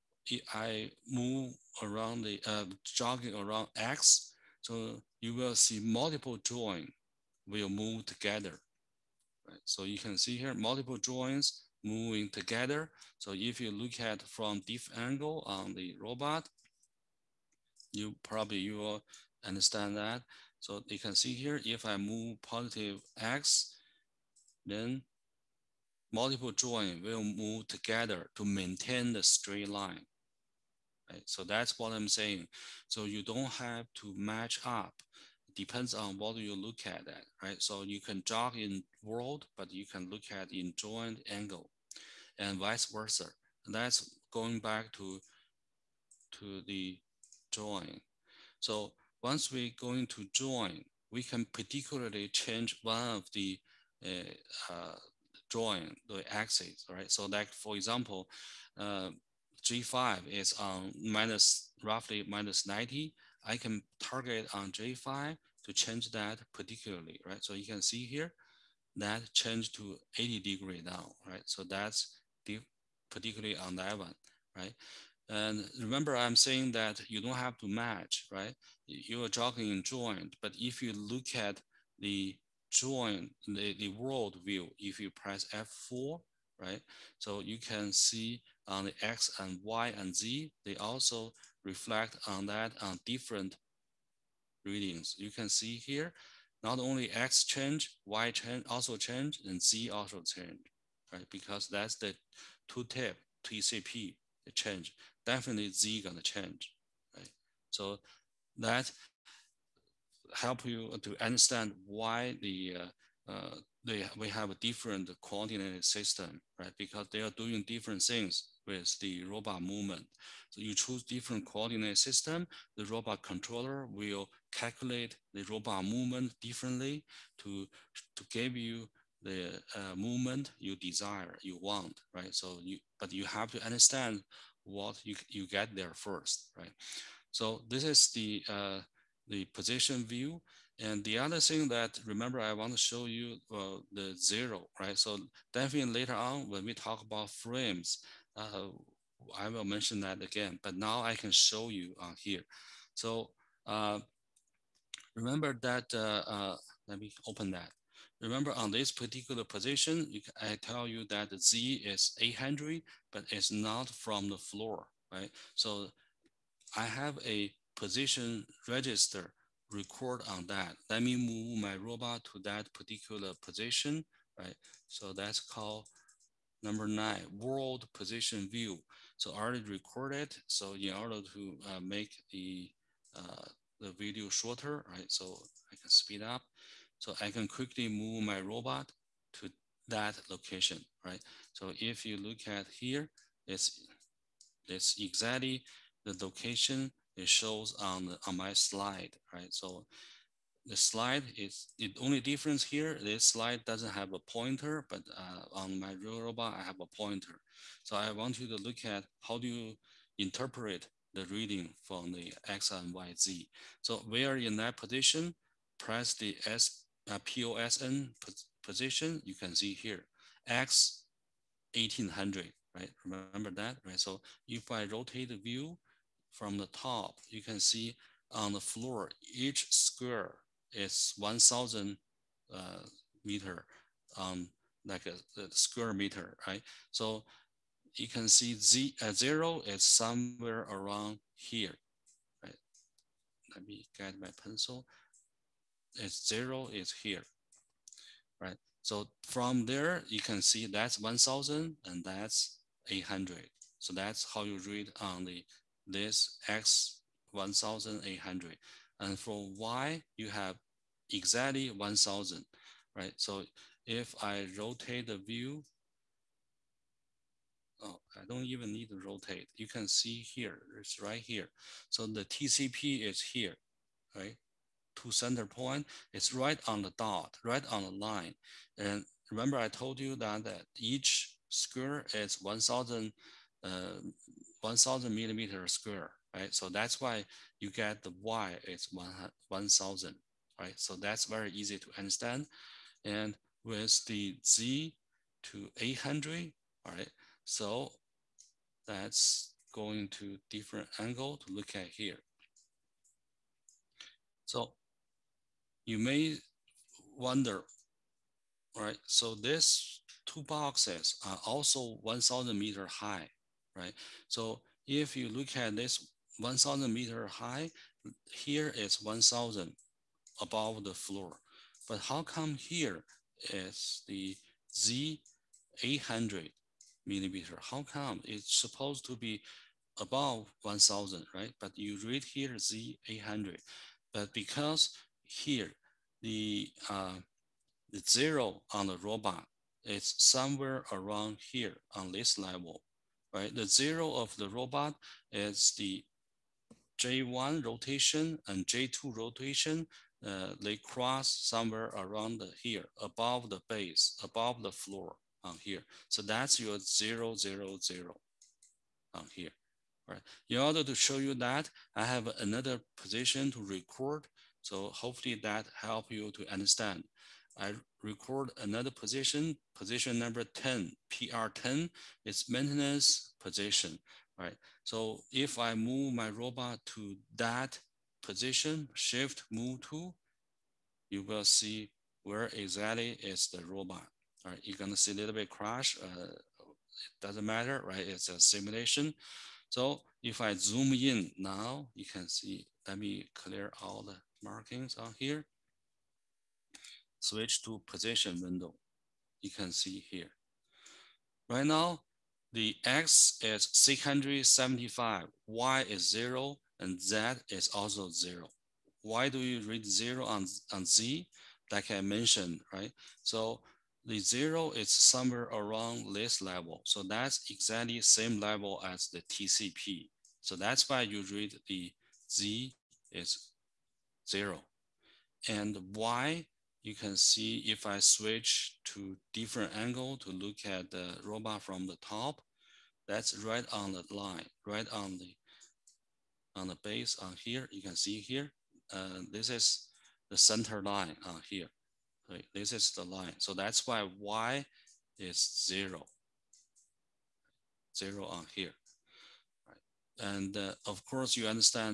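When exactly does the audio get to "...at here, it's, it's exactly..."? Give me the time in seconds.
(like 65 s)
192 s.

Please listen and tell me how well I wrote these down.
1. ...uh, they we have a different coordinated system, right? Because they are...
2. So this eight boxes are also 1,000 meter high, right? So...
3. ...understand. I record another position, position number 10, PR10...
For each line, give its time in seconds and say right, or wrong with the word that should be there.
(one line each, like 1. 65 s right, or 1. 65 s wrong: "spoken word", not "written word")
1. 113 s right
2. 309 s wrong: "two", not "eight"
3. 366 s right.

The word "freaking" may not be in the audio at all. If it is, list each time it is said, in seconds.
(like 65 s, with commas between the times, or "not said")
not said.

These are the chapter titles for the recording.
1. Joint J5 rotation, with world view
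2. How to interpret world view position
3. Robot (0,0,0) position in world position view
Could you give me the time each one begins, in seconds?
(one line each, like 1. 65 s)
1. 59 s
2. 149 s
3. 359 s.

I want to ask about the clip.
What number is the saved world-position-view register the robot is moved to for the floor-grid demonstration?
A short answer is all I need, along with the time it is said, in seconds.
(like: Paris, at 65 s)
9, at 176 s.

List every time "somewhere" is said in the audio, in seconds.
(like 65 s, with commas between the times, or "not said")
239 s, 340 s, 351 s, 414 s.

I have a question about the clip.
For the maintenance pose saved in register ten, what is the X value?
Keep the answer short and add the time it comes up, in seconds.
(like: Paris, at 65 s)
675, at 403 s.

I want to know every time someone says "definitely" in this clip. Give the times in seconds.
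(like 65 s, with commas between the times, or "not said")
105 s, 145 s.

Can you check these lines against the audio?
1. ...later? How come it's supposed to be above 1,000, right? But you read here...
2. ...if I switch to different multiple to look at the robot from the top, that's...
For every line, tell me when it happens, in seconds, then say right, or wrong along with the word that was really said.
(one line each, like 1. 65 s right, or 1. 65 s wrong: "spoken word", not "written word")
1. 327 s wrong: "millimeter", not "later"
2. 427 s wrong: "angle", not "multiple".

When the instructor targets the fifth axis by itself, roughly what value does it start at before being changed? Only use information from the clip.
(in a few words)
-90.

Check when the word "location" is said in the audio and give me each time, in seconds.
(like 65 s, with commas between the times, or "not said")
190 s, 196 s.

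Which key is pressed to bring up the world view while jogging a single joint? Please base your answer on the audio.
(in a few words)
F4.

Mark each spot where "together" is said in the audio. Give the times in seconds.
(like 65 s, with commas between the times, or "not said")
8 s, 12 s, 27 s.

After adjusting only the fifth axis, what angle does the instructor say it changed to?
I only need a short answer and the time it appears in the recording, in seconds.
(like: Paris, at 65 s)
80 degrees, at 70 s.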